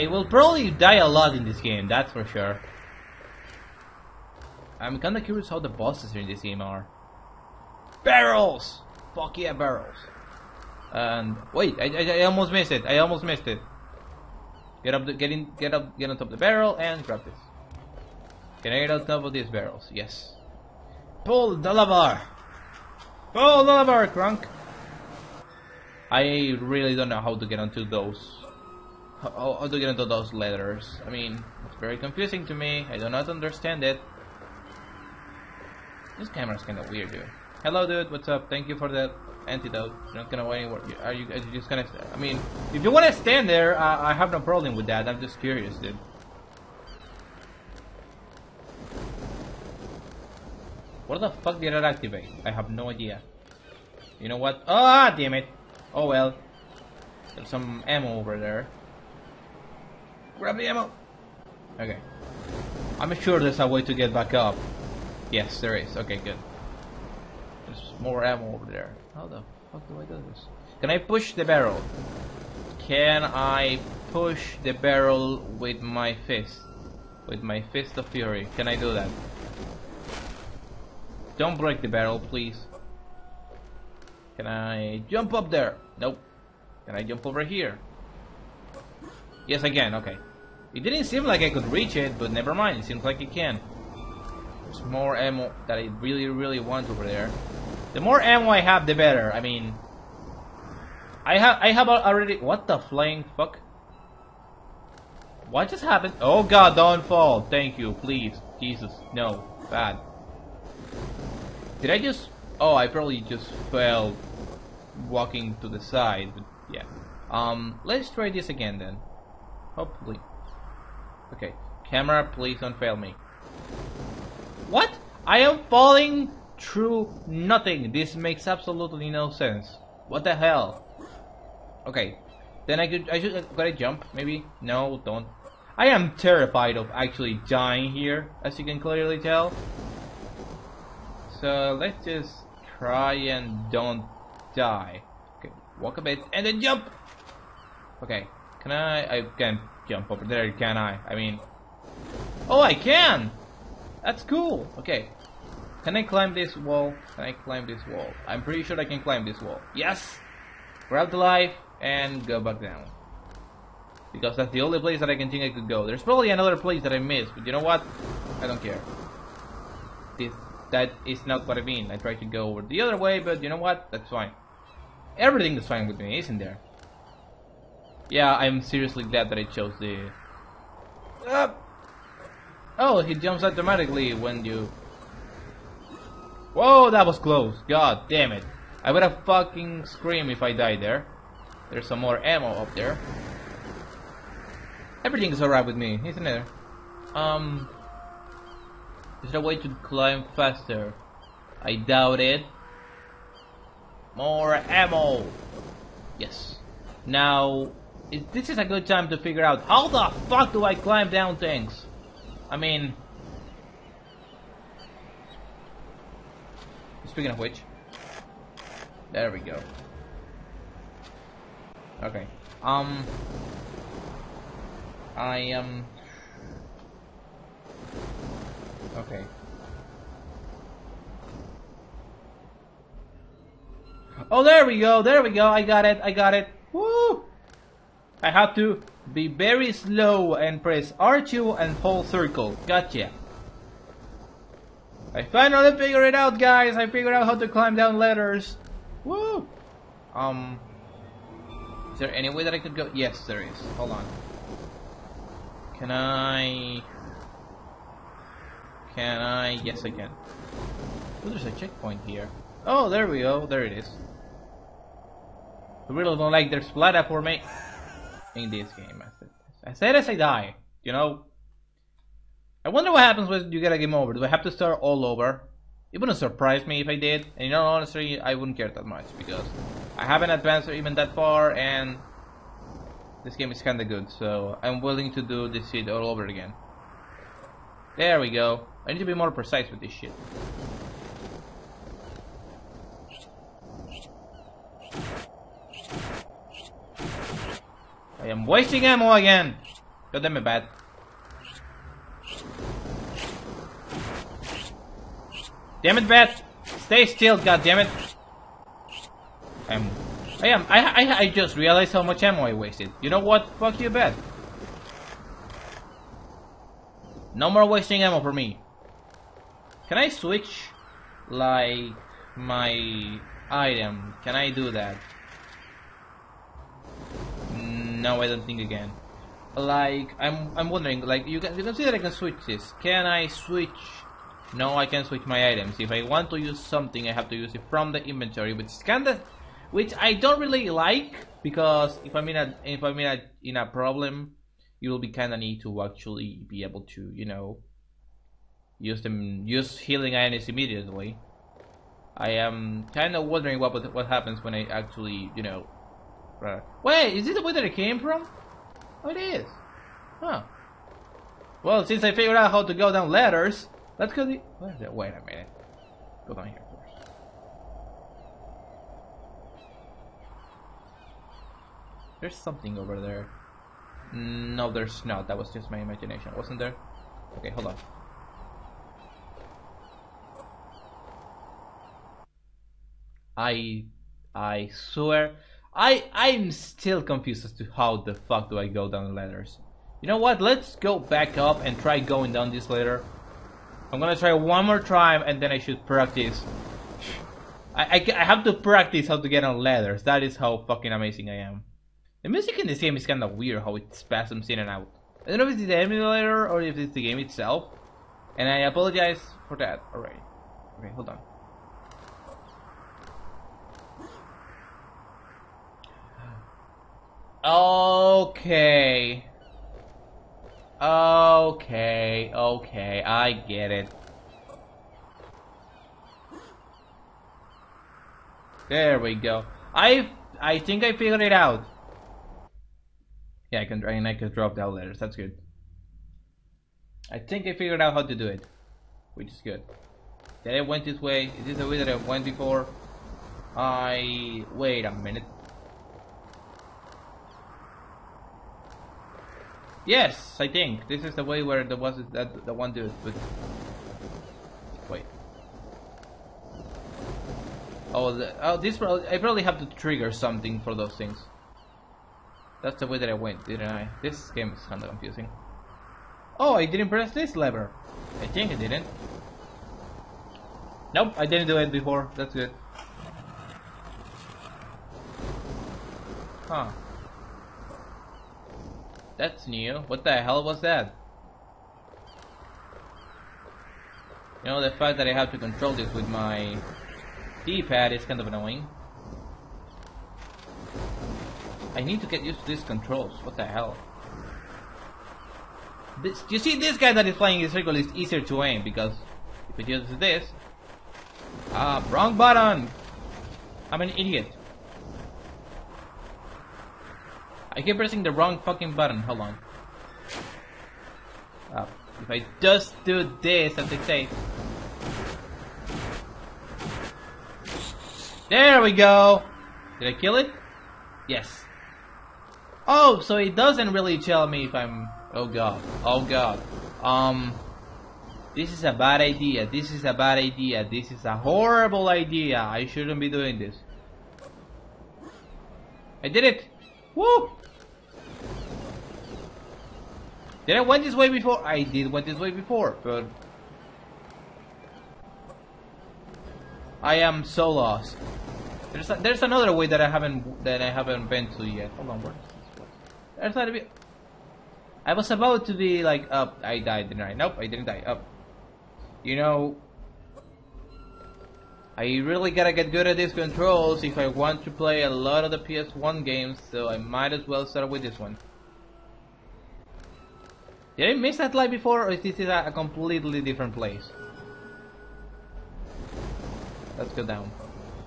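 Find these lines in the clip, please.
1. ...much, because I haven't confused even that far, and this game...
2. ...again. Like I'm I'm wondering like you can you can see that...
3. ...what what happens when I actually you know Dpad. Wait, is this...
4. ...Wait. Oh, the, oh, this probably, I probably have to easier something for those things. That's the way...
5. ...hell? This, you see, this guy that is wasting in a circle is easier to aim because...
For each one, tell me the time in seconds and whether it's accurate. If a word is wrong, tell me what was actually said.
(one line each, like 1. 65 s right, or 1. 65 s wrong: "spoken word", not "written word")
1. 278 s wrong: "advanced", not "confused"
2. 328 s right
3. 353 s wrong: "Right", not "Dpad"
4. 454 s wrong: "trigger", not "easier"
5. 493 s wrong: "flying", not "wasting".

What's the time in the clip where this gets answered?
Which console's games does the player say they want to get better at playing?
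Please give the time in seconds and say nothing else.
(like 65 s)
565 s.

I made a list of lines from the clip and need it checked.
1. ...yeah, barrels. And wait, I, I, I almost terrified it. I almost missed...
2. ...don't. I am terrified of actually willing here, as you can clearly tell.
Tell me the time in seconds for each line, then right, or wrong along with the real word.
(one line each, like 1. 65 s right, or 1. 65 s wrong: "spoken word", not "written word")
1. 9 s wrong: "missed", not "terrified"
2. 135 s wrong: "dying", not "willing".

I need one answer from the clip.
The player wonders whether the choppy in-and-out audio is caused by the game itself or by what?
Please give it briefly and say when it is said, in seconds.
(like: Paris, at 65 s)
the emulator, at 405 s.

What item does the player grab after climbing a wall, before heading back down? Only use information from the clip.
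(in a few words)
life.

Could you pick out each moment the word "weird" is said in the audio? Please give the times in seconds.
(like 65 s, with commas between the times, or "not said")
36 s, 403 s.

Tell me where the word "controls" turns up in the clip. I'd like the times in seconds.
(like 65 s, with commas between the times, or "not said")
485 s, 492 s, 563 s.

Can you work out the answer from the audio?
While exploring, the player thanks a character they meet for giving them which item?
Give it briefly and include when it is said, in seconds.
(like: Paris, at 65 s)
antidote, at 39 s.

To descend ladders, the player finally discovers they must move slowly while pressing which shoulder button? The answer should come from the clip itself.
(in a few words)
R2.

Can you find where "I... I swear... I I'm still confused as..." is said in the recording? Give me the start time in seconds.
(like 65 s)
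383 s.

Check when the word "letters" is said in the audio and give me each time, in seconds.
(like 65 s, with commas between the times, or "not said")
30 s, 434 s.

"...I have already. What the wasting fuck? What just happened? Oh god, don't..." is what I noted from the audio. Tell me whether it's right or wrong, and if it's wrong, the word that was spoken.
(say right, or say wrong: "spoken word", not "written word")
wrong: "flying", not "wasting".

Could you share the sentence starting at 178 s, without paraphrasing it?
Yeah, I'm seriously glad that I chose the...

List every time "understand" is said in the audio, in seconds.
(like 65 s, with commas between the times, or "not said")
33 s.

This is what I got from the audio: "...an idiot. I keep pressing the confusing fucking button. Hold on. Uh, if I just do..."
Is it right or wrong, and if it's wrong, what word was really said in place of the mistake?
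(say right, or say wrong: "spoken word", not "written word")
wrong: "wrong", not "confusing".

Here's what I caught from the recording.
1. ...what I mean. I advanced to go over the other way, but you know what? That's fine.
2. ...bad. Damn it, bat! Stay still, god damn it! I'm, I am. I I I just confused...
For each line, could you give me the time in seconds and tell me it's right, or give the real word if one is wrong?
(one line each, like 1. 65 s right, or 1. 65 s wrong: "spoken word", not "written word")
1. 171 s wrong: "tried", not "advanced"
2. 300 s wrong: "realized", not "confused".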